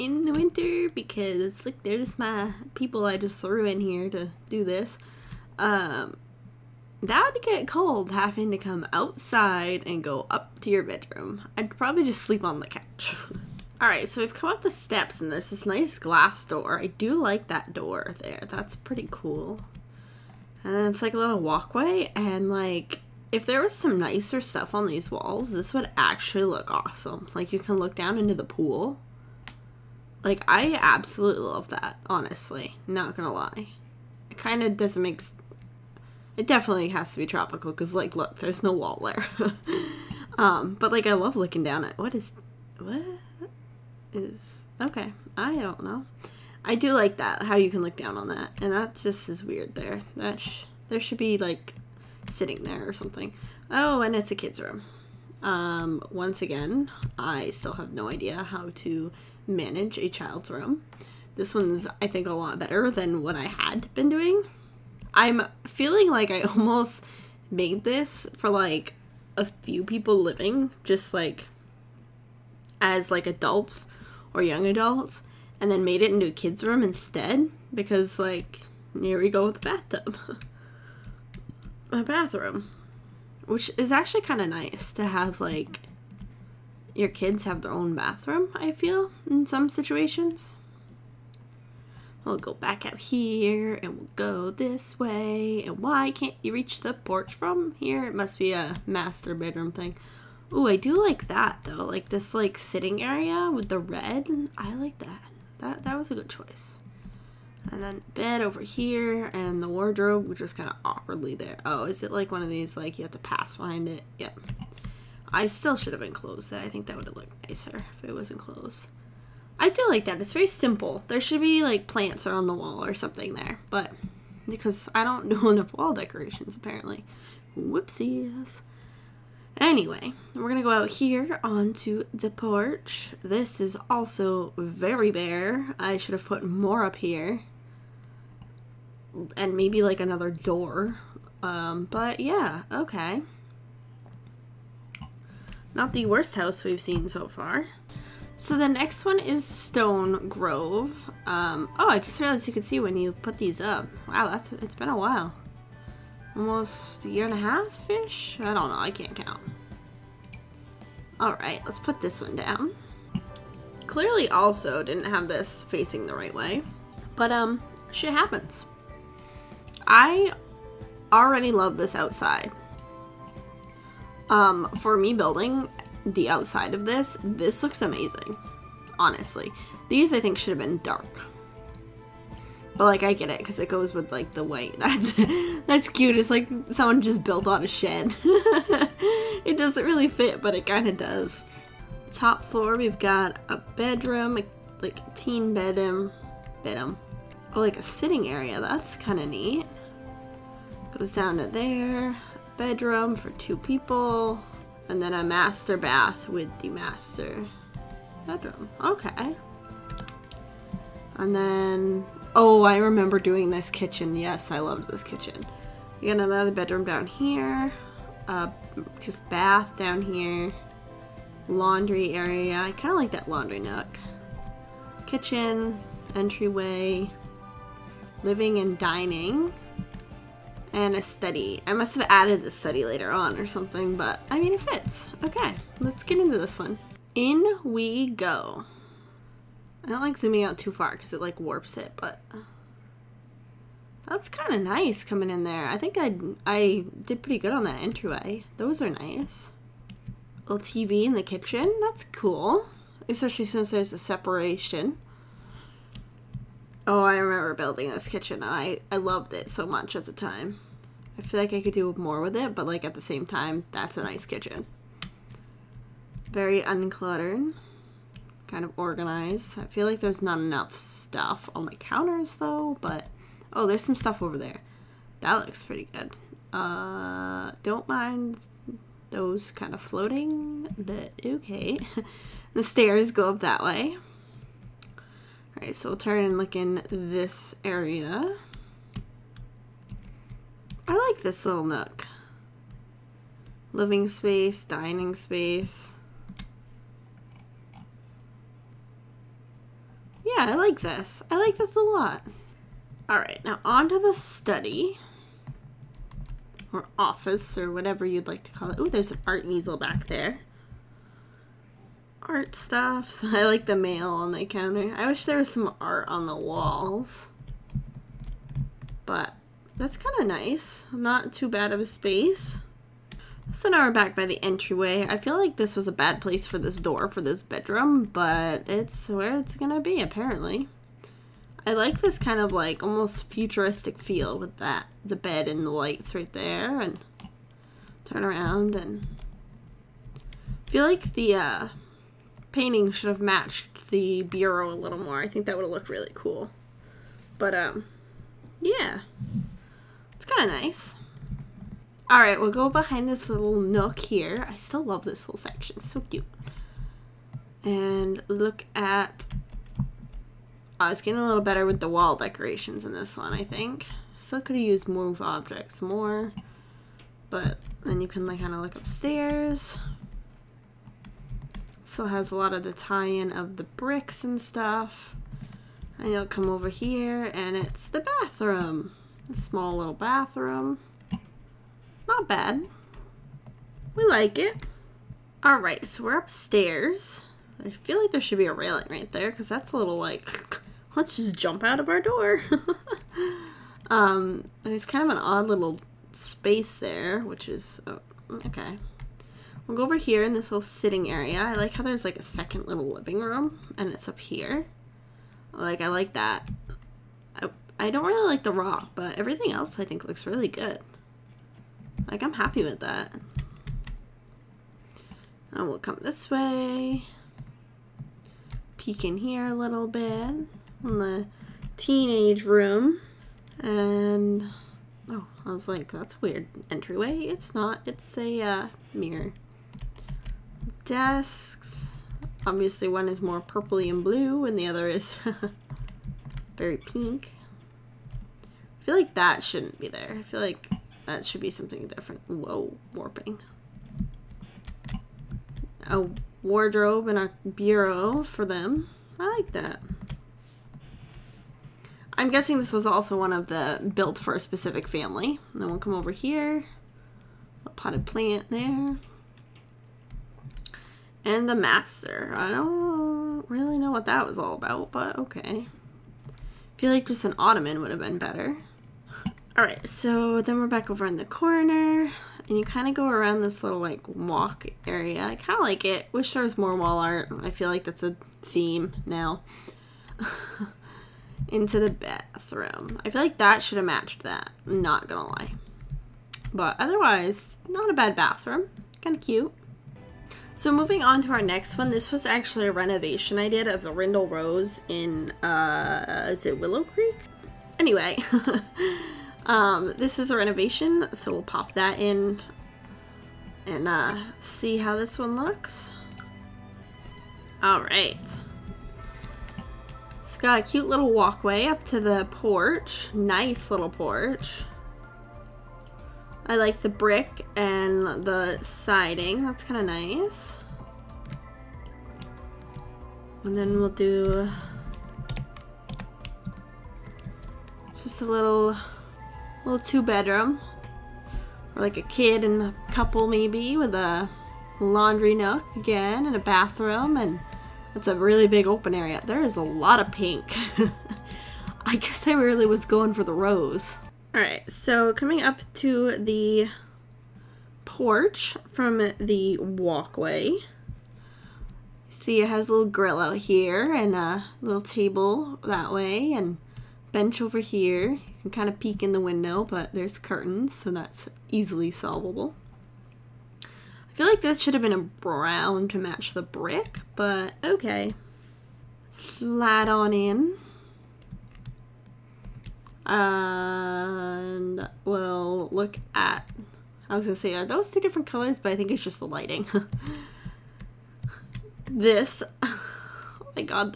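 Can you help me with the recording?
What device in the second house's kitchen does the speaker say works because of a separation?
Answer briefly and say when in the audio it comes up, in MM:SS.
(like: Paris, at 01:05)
TV, at 04:10.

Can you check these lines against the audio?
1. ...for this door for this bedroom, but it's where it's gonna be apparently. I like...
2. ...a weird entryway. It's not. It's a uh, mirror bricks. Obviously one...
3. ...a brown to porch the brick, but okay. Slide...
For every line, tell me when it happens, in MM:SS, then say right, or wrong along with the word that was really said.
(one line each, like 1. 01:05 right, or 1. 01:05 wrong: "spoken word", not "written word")
1. 05:26 right
2. 07:06 wrong: "desks", not "bricks"
3. 09:24 wrong: "match", not "porch".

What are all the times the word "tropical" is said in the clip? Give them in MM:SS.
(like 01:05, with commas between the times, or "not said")
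00:37.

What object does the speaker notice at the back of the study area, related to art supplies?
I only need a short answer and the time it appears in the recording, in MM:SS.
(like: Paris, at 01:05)
art easel, at 05:09.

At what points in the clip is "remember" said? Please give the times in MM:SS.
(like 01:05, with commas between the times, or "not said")
03:32, 04:17.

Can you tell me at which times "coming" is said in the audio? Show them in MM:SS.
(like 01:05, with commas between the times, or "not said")
04:05, 09:05.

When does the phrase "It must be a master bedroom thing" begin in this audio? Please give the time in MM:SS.
01:38.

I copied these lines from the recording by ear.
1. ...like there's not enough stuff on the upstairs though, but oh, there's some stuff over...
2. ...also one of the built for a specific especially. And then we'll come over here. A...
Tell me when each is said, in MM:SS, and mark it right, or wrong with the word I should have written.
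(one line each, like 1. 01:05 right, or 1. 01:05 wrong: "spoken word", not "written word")
1. 04:29 wrong: "counters", not "upstairs"
2. 07:32 wrong: "family", not "especially".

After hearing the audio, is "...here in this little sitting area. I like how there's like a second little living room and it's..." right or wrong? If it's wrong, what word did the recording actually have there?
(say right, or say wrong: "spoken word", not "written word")
right.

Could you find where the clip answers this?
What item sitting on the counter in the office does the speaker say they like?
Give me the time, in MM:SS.
05:13.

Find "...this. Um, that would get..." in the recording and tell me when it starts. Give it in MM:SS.
00:04.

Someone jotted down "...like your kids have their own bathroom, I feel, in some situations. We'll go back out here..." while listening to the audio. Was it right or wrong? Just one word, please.
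right.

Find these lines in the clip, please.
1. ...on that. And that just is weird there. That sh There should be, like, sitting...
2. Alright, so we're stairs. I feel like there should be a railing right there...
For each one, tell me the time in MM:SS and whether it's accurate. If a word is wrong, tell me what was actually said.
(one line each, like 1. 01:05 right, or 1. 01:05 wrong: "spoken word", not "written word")
1. 00:48 right
2. 06:25 wrong: "upstairs", not "stairs".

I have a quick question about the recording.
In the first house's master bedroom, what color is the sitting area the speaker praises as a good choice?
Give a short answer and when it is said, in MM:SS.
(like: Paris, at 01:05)
red, at 01:43.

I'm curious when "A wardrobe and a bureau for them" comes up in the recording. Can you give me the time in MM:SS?
07:25.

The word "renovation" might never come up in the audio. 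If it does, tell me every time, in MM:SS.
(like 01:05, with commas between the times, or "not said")
08:12, 08:20.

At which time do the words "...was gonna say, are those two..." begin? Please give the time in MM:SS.
09:37.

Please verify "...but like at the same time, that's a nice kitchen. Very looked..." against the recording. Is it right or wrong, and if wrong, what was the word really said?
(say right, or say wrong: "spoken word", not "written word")
wrong: "uncluttered", not "looked".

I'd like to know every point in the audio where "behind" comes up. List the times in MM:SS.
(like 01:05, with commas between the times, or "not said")
01:53, 05:52.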